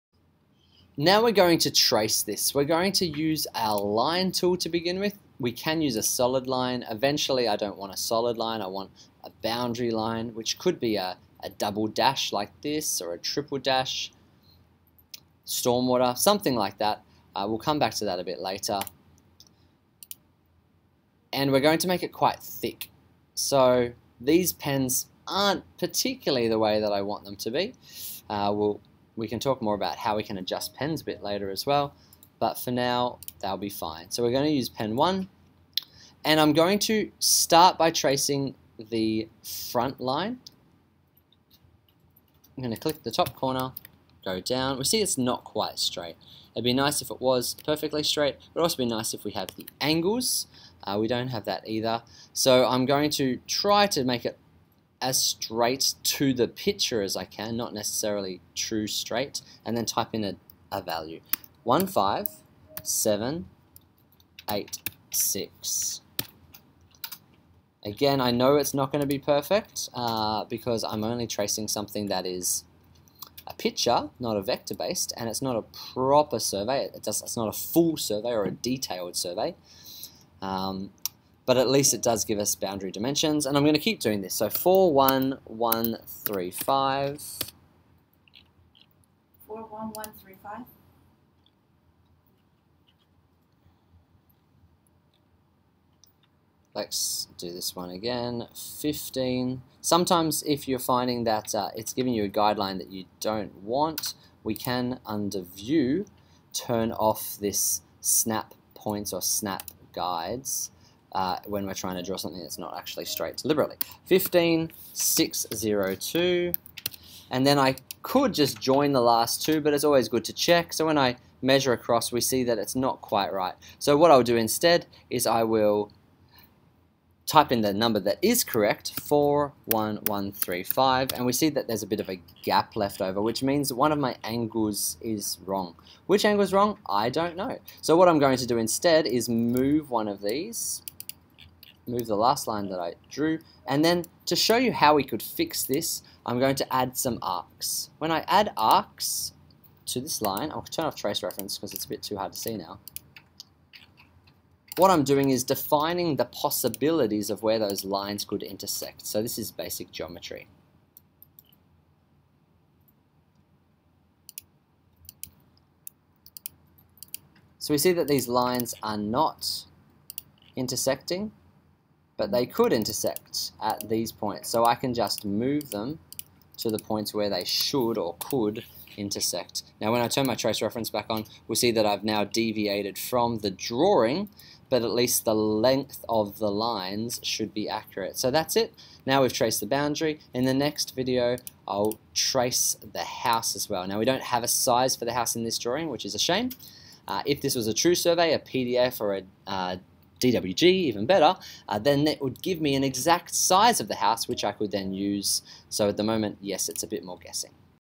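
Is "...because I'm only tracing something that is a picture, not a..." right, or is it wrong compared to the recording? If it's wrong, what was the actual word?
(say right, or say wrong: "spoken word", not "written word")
right.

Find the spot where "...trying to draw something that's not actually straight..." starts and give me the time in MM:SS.
01:51.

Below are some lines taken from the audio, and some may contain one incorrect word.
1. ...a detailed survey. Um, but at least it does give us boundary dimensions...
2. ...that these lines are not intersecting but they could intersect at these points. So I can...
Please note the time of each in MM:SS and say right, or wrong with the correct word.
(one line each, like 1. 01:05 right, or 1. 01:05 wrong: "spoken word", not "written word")
1. 01:18 right
2. 02:47 right.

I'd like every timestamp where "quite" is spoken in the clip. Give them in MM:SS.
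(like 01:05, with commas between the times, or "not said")
00:22, 00:45, 02:03.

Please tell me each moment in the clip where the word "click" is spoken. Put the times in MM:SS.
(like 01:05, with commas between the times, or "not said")
00:42.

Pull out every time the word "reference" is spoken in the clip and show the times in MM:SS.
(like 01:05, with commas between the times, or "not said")
02:31, 03:00.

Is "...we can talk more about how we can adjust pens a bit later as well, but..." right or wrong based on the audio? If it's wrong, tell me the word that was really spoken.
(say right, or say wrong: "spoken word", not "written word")
right.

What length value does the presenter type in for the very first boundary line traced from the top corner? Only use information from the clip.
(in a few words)
15786.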